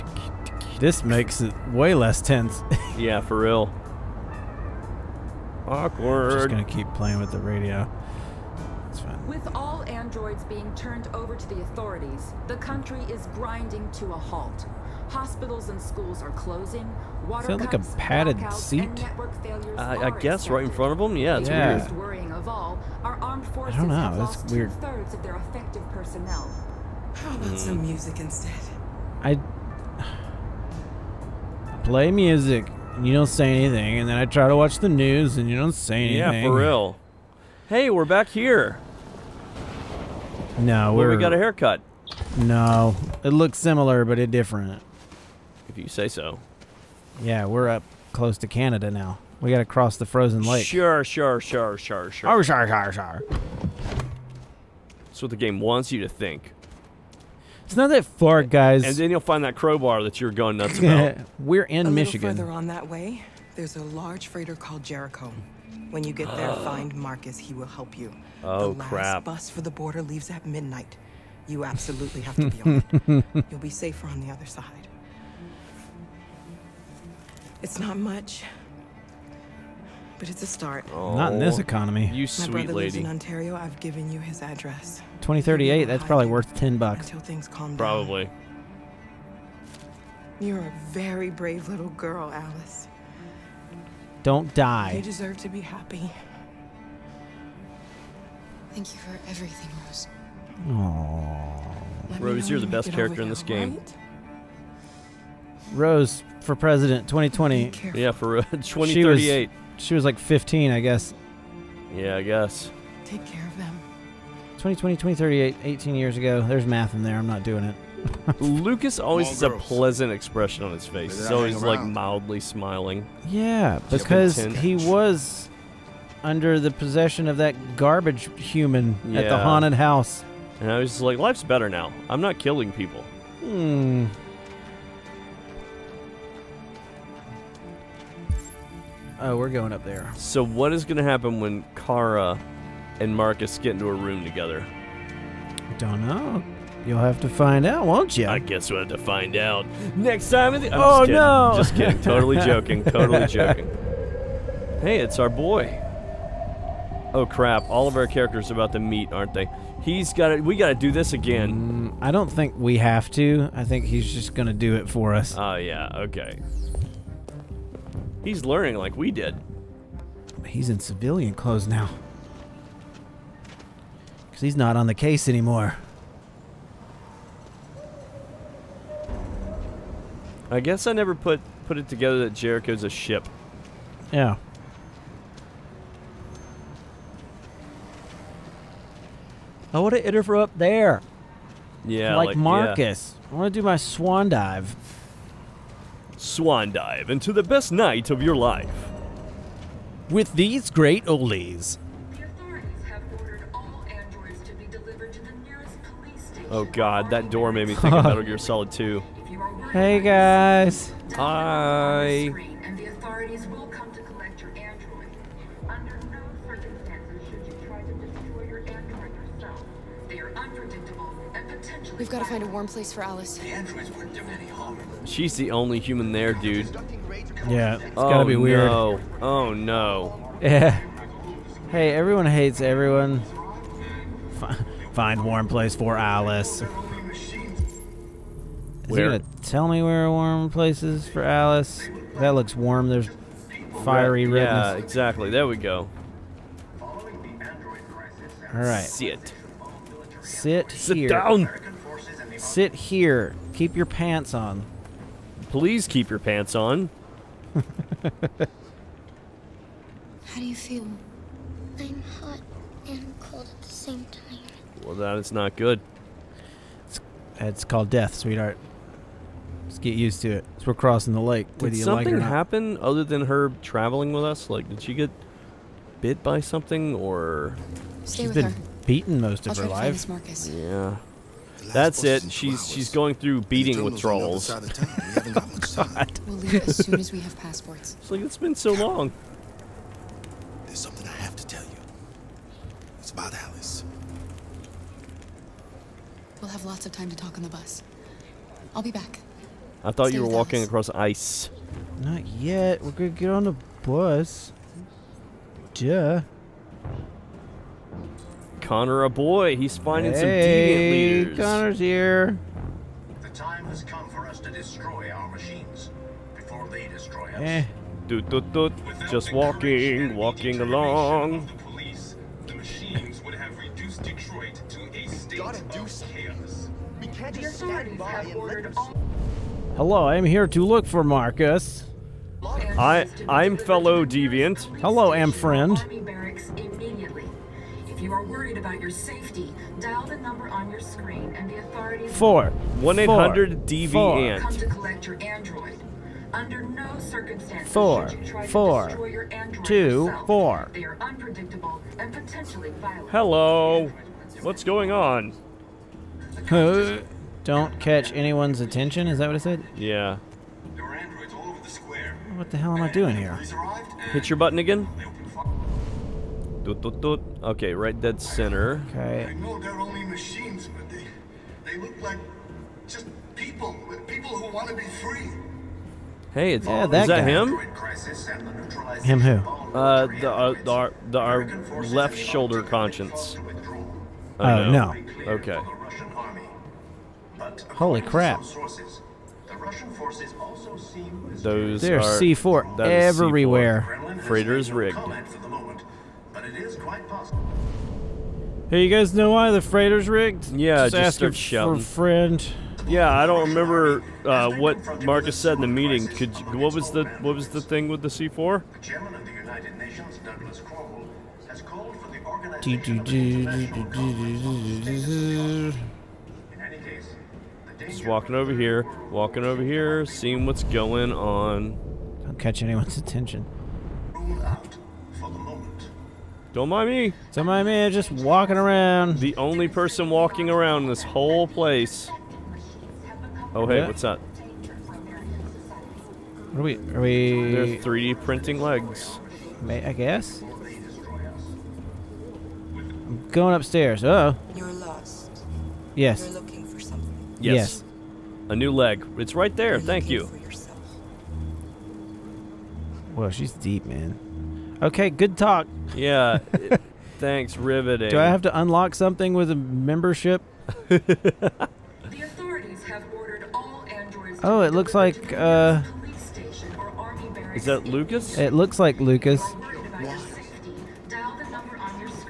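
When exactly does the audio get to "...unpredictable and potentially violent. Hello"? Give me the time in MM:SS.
05:51.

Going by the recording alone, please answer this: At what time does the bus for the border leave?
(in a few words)
Midnight.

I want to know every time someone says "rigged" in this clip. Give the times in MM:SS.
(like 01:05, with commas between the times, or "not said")
06:34, 06:40.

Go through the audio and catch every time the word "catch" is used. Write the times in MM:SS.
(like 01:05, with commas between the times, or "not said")
05:57, 07:02.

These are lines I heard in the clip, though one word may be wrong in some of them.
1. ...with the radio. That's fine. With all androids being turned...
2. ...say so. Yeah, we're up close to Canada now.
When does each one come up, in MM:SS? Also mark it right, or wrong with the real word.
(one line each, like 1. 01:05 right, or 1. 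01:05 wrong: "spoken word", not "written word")
1. 00:07 right
2. 00:45 right.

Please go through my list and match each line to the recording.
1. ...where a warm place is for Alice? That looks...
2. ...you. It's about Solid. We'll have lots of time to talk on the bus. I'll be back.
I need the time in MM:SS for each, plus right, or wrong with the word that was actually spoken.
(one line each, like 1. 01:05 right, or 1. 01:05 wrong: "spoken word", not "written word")
1. 03:59 right
2. 04:51 wrong: "Alice", not "Solid".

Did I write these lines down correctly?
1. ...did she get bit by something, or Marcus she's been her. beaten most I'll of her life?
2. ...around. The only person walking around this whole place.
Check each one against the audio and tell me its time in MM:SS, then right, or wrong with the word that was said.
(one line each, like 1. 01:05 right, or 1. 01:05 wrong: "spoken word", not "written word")
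1. 04:34 wrong: "Stay", not "Marcus"
2. 07:08 right.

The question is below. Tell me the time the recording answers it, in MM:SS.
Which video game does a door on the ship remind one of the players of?
03:28.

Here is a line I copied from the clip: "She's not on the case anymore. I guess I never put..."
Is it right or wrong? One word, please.
right.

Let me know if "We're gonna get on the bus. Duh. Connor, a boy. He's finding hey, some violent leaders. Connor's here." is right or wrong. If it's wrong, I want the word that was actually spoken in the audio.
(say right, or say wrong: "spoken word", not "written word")
wrong: "deviant", not "violent".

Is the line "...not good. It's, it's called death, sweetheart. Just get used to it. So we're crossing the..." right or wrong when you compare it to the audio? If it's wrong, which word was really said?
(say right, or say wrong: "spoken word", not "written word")
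right.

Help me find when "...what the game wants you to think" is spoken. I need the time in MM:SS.
00:55.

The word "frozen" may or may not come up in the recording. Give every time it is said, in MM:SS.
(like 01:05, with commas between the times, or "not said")
00:50.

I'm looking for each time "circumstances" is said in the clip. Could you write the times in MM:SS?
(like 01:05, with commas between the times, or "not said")
05:46.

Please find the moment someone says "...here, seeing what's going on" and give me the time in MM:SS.
06:59.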